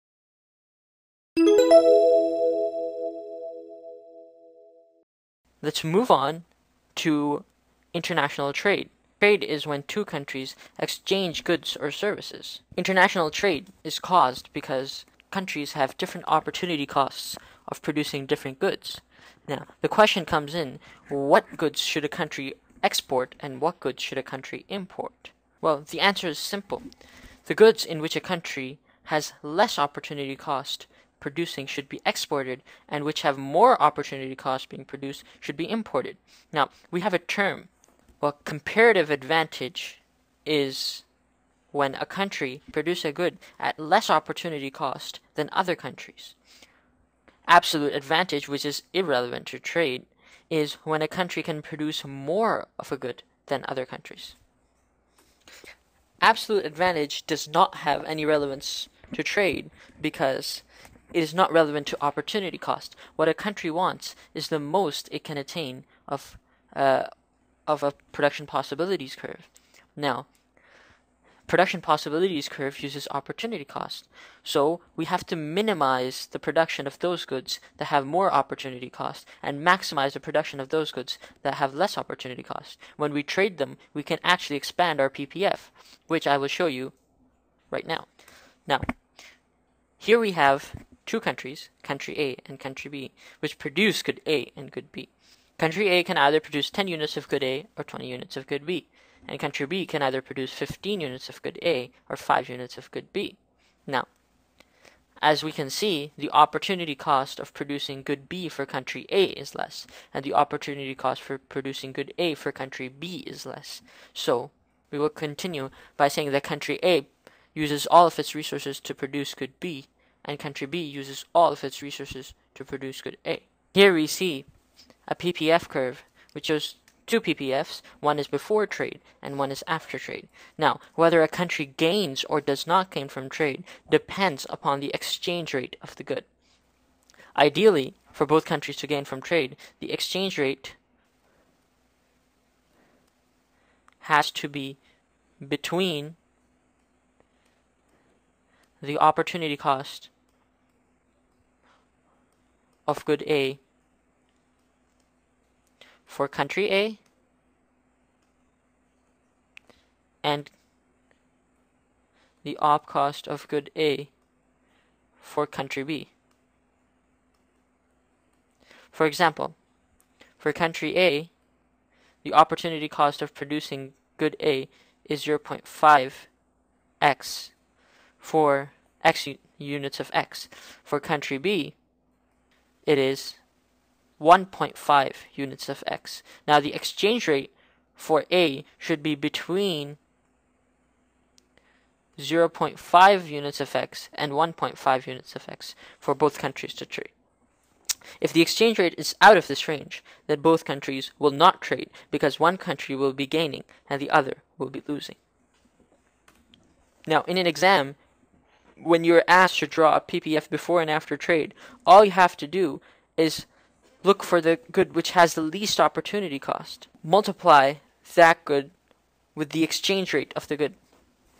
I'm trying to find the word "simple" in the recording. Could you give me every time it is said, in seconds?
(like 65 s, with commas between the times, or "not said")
26 s.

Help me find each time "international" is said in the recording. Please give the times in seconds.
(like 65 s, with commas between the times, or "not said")
7 s, 12 s.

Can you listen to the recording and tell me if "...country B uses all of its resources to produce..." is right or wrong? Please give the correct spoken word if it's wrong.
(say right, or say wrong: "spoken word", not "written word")
right.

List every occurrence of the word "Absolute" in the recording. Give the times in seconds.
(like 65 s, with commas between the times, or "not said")
47 s, 56 s.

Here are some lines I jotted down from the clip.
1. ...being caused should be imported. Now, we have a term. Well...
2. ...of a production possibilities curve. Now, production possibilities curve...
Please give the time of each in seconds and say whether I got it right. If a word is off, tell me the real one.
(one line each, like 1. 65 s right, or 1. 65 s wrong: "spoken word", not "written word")
1. 34 s wrong: "produced", not "caused"
2. 67 s right.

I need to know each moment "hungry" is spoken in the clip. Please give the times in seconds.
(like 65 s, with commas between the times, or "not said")
not said.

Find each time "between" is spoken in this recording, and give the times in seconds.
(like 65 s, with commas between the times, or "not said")
145 s, 189 s.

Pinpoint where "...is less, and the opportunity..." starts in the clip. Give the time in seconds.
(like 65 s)
109 s.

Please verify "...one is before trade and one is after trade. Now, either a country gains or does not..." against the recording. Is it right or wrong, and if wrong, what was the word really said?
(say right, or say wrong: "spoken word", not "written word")
wrong: "whether", not "either".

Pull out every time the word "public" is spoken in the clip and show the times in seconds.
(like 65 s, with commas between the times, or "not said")
not said.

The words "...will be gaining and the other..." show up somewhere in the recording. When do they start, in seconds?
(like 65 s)
202 s.